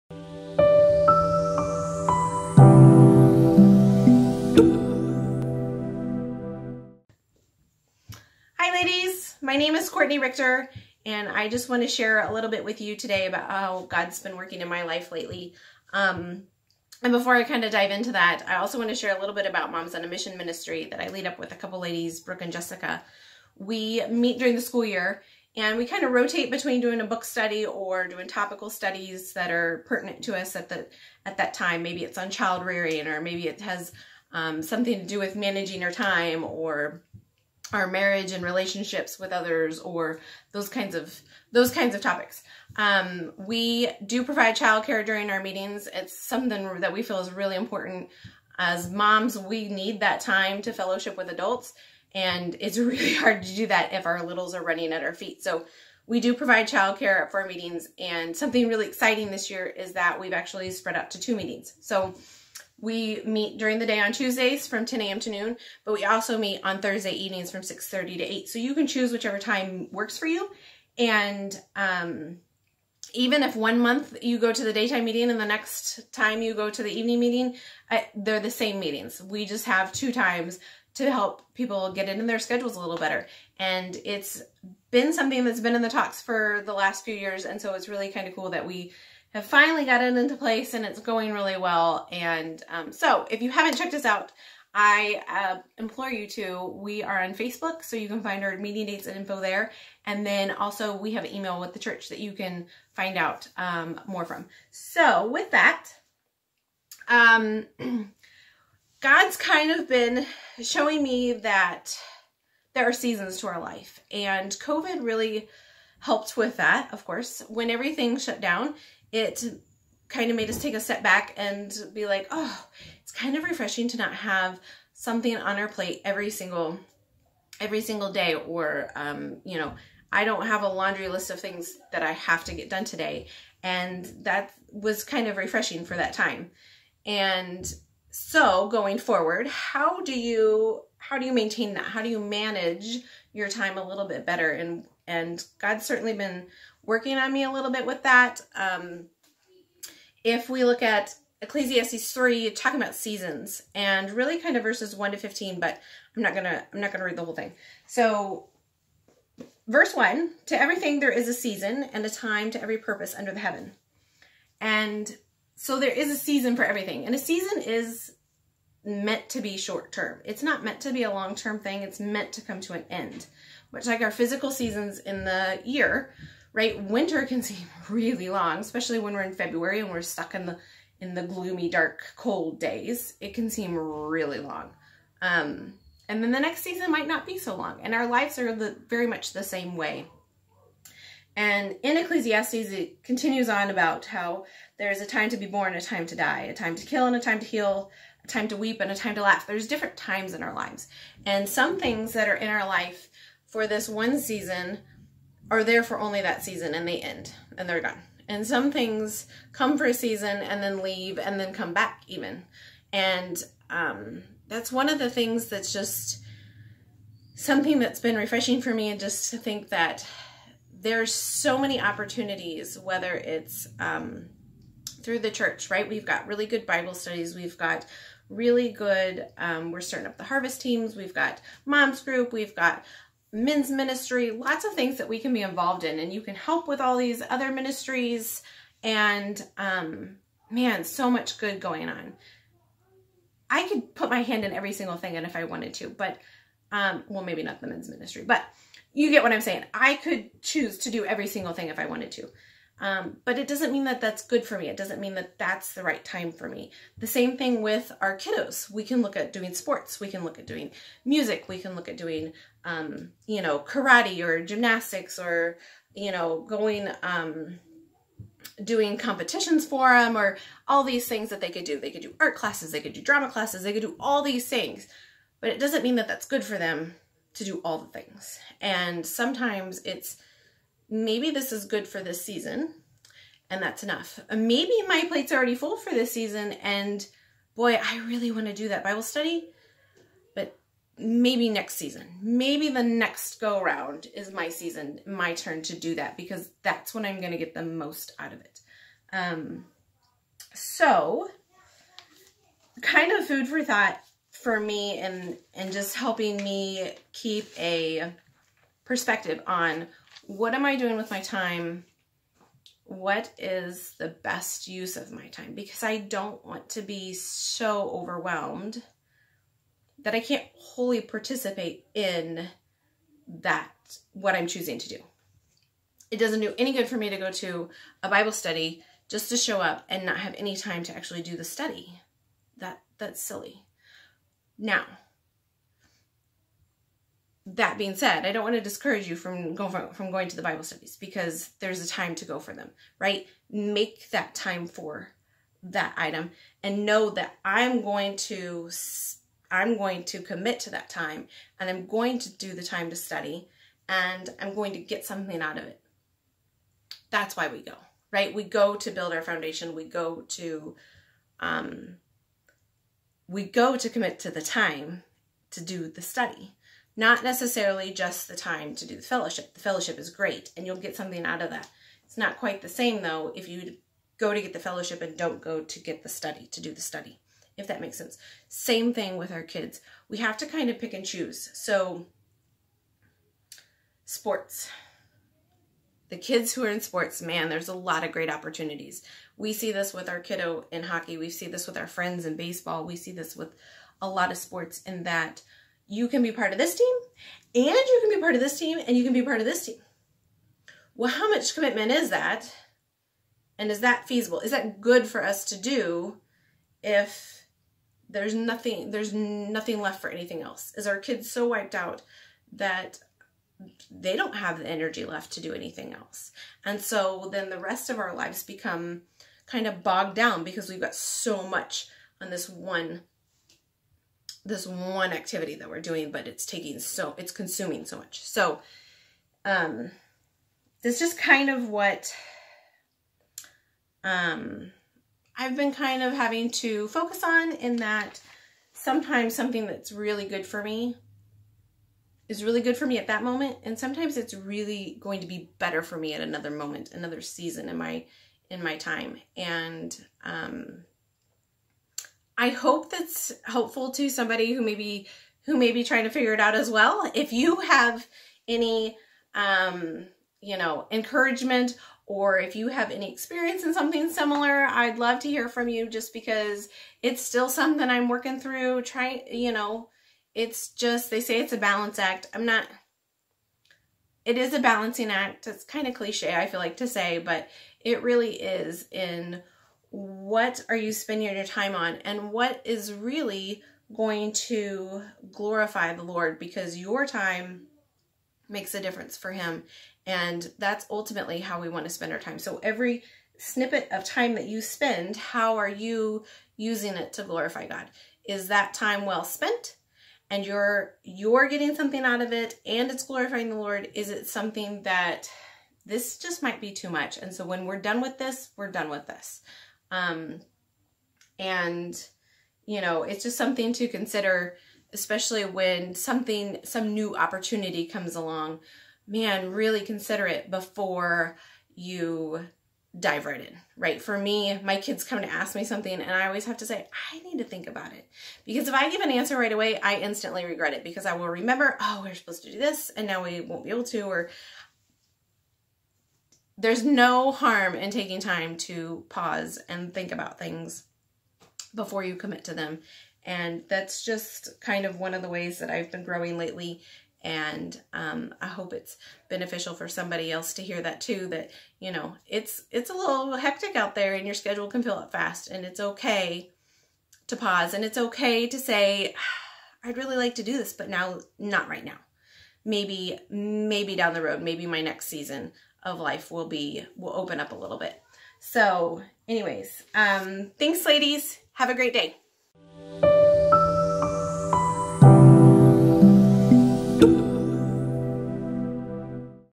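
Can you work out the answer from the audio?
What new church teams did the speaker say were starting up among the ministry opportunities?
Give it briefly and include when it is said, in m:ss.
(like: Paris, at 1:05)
harvest teams, at 3:50.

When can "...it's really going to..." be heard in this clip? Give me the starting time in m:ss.
7:24.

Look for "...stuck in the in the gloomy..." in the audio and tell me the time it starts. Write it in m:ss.
3:00.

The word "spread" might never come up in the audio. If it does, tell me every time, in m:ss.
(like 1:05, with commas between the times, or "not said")
1:00.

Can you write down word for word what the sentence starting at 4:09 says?
I could choose to do every single thing if I wanted to.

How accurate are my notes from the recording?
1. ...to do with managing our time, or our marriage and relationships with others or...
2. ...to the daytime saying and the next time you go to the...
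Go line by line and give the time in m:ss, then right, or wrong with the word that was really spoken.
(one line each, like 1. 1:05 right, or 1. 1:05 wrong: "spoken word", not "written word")
1. 0:35 right
2. 1:14 wrong: "meeting", not "saying".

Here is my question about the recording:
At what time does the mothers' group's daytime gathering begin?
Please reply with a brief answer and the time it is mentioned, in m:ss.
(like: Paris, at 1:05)
10 a.m., at 1:04.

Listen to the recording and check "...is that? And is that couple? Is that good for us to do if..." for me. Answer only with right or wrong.
wrong.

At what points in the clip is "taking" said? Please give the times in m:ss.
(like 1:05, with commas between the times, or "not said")
7:06, 8:57.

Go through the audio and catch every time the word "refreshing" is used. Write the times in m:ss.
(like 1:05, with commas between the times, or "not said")
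2:03, 2:15, 3:38.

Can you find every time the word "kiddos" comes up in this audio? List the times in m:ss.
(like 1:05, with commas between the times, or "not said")
4:18, 6:30.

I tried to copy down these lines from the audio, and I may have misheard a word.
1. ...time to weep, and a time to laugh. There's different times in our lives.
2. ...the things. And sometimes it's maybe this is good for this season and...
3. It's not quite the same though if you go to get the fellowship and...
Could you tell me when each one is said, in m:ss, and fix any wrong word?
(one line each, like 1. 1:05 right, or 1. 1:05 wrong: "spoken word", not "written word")
1. 3:18 right
2. 4:37 right
3. 6:12 right.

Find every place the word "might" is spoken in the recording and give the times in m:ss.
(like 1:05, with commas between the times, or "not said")
3:06, 8:26.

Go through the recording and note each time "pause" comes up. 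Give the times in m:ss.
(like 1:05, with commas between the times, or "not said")
8:59, 9:17.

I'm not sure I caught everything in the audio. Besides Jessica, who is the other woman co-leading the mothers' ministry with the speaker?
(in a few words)
Brooke.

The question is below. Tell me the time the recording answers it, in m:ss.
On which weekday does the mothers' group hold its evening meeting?
1:06.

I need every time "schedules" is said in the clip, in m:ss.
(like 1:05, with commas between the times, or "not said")
1:22, 9:14.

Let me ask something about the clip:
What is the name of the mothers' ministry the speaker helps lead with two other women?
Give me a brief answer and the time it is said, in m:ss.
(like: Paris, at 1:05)
Moms on a Mission, at 0:19.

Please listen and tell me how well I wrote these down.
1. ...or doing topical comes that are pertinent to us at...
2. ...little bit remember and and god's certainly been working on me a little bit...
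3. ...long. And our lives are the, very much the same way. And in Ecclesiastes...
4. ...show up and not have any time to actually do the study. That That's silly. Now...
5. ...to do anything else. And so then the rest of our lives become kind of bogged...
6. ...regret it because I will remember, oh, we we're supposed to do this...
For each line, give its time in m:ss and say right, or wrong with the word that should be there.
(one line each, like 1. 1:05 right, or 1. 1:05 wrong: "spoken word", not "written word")
1. 0:27 wrong: "studies", not "comes"
2. 2:23 wrong: "better", not "remember"
3. 3:07 right
4. 5:29 right
5. 6:55 right
6. 8:50 right.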